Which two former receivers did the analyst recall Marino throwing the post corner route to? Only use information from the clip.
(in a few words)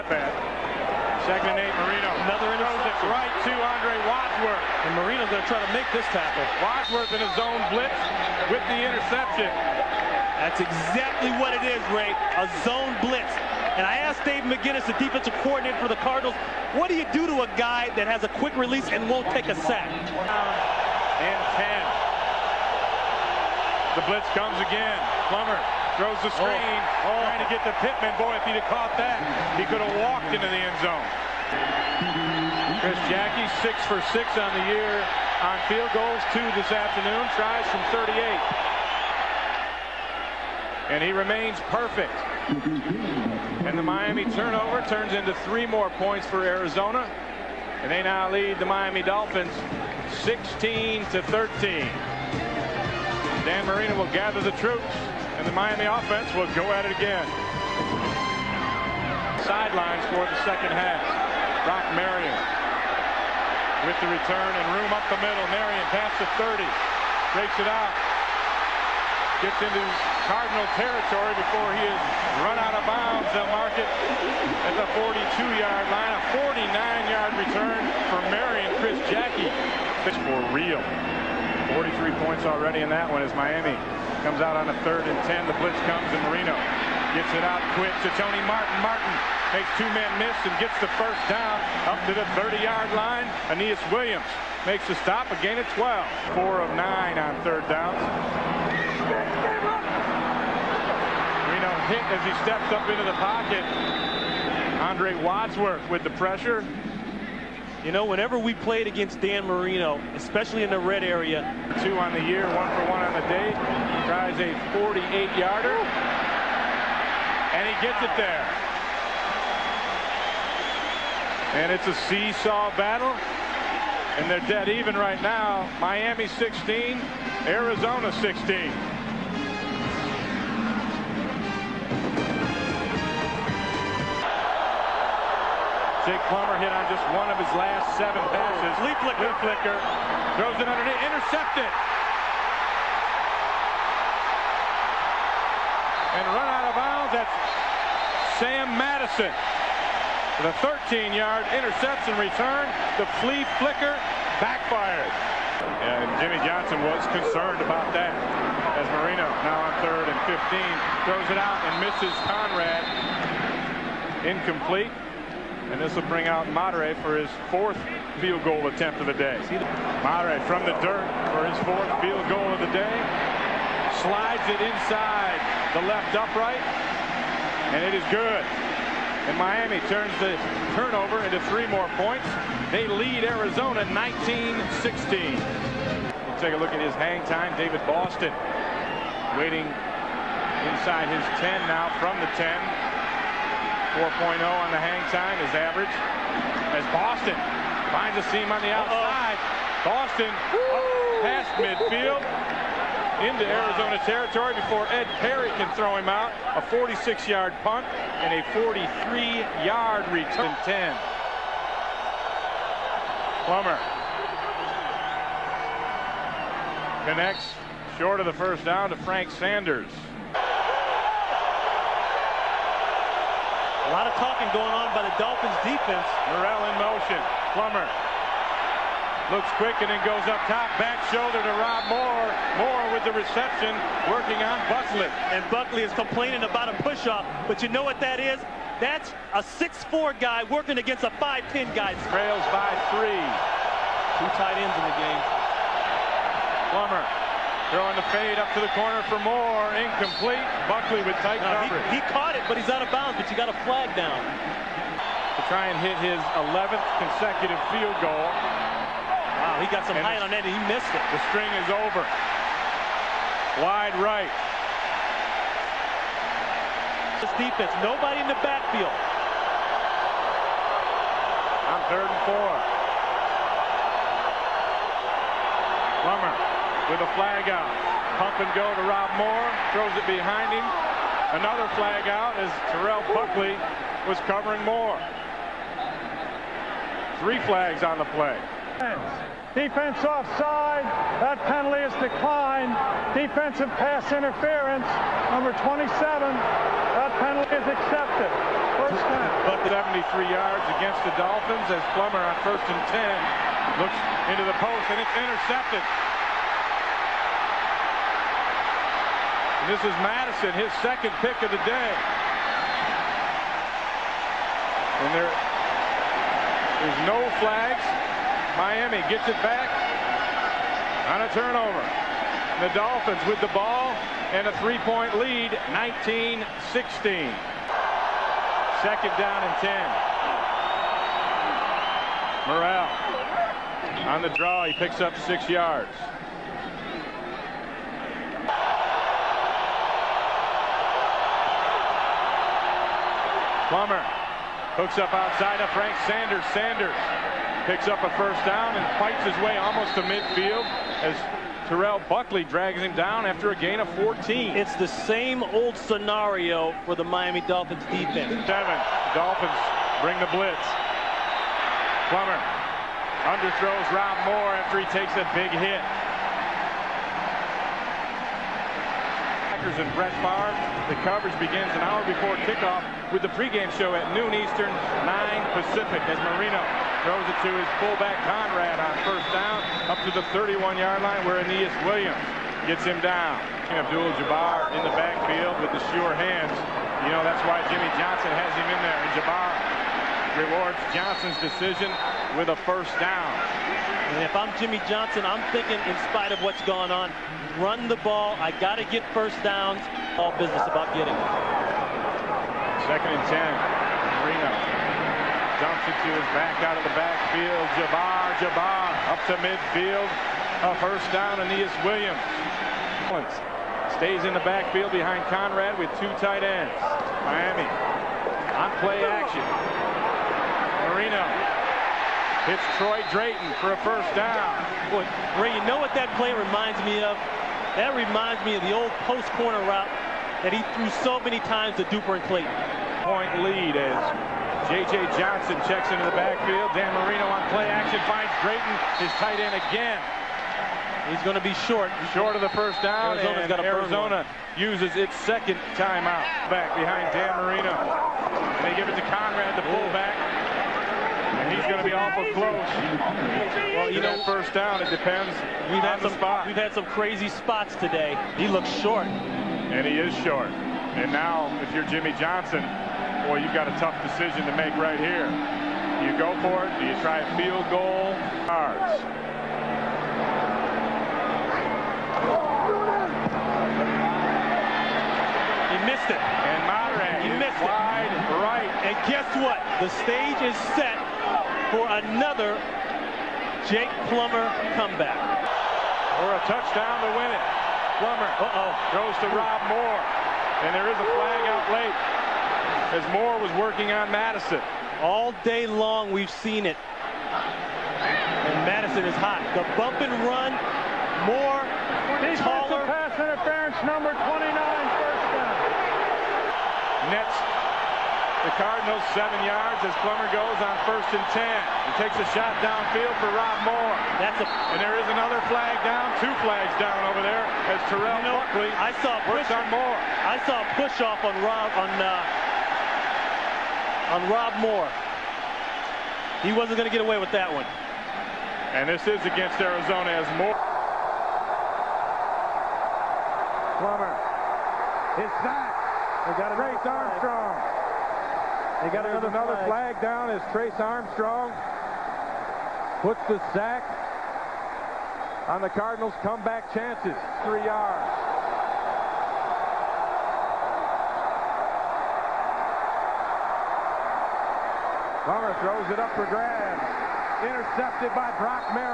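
Duper and Clayton.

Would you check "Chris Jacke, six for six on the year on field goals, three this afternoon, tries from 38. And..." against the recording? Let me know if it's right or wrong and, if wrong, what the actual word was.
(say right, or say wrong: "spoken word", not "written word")
wrong: "two", not "three".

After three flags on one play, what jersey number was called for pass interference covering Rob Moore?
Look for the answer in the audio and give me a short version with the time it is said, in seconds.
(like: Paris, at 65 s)
27, at 295 s.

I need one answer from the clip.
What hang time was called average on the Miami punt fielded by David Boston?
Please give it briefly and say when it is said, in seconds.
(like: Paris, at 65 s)
4.0, at 193 s.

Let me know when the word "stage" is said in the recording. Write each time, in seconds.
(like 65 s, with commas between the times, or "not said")
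480 s.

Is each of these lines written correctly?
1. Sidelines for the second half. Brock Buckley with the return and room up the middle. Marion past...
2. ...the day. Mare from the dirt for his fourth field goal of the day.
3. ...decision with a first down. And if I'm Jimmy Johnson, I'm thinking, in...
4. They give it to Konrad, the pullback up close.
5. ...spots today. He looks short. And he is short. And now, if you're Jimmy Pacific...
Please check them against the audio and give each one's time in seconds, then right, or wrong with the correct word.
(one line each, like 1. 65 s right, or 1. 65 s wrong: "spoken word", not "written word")
1. 59 s wrong: "Marion", not "Buckley"
2. 169 s right
3. 391 s right
4. 448 s right
5. 457 s wrong: "Johnson", not "Pacific".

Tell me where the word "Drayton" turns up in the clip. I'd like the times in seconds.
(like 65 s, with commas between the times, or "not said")
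423 s, 438 s.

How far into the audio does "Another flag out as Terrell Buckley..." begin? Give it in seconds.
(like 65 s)
281 s.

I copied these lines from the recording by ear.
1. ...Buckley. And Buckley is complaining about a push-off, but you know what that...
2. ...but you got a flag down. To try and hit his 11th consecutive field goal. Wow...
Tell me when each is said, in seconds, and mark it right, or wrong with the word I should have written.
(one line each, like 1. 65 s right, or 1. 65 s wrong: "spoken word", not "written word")
1. 234 s right
2. 253 s right.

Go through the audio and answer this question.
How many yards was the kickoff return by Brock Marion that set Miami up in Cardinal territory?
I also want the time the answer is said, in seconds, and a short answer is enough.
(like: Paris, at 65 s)
49, at 76 s.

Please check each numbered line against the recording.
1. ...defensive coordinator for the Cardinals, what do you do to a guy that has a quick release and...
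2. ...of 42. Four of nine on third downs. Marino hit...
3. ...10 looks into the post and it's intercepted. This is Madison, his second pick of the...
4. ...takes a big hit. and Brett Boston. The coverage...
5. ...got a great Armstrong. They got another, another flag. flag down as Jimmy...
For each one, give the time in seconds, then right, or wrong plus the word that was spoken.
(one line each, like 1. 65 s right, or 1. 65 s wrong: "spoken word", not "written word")
1. 14 s right
2. 95 s wrong: "12", not "42"
3. 302 s right
4. 364 s wrong: "Favre", not "Boston"
5. 536 s wrong: "Trace", not "Jimmy".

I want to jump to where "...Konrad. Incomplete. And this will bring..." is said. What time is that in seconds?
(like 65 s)
162 s.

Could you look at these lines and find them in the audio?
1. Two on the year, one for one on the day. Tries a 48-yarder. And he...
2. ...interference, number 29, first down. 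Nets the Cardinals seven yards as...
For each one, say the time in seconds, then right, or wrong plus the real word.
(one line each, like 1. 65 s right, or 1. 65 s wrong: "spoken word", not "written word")
1. 111 s right
2. 503 s right.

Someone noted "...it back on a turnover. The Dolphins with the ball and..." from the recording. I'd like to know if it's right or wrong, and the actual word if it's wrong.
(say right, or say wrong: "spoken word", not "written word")
right.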